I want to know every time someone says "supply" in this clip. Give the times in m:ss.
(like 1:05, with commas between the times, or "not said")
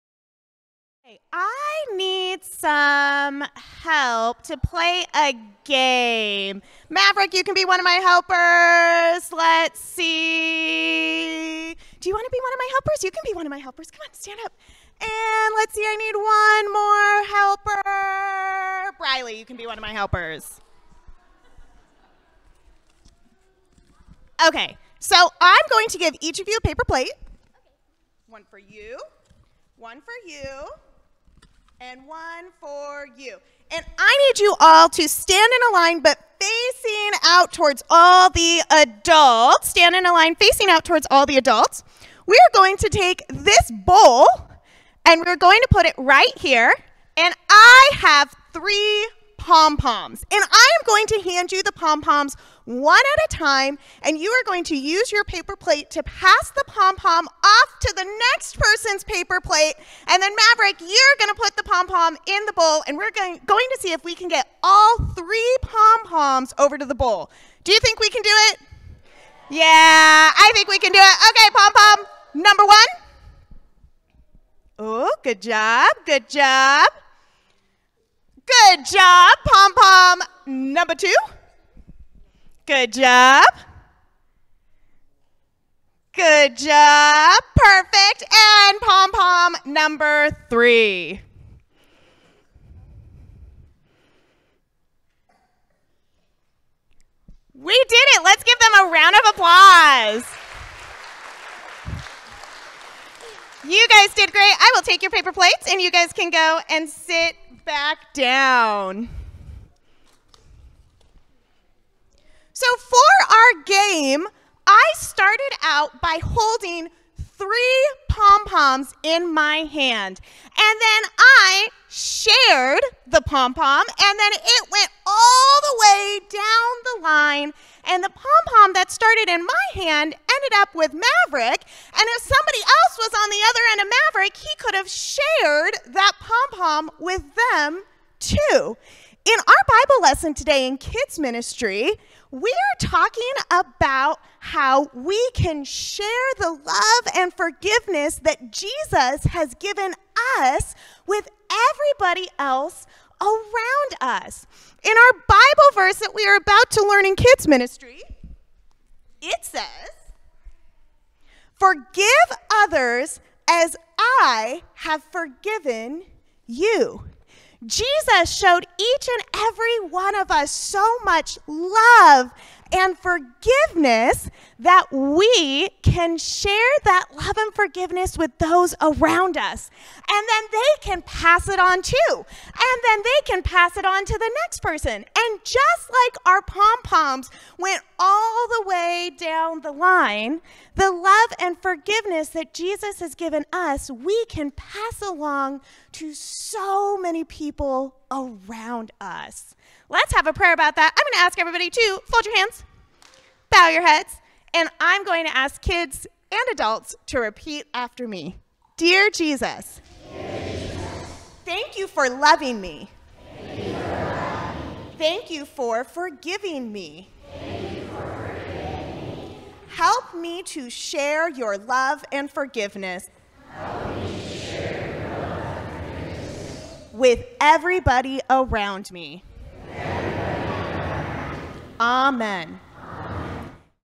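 not said.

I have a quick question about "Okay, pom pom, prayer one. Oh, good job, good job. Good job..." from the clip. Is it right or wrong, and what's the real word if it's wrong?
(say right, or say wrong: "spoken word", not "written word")
wrong: "number", not "prayer".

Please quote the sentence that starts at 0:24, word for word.
Okay, so I'm going to give each of you a paper plate.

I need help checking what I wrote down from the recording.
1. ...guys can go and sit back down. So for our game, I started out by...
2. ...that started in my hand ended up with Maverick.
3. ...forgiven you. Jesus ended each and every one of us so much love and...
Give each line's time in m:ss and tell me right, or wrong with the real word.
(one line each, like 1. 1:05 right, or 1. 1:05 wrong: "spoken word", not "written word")
1. 1:45 right
2. 2:08 right
3. 2:45 wrong: "showed", not "ended".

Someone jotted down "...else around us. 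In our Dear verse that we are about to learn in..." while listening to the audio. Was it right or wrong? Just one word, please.
wrong.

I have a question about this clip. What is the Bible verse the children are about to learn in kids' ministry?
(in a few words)
Forgive others as I have forgiven you.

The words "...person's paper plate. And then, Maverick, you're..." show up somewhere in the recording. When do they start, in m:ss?
0:58.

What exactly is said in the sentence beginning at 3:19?
Let's have a prayer about that.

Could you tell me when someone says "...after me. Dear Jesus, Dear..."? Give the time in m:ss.
3:27.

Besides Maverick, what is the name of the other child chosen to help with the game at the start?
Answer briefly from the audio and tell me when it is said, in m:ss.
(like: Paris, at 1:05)
Briley, at 0:18.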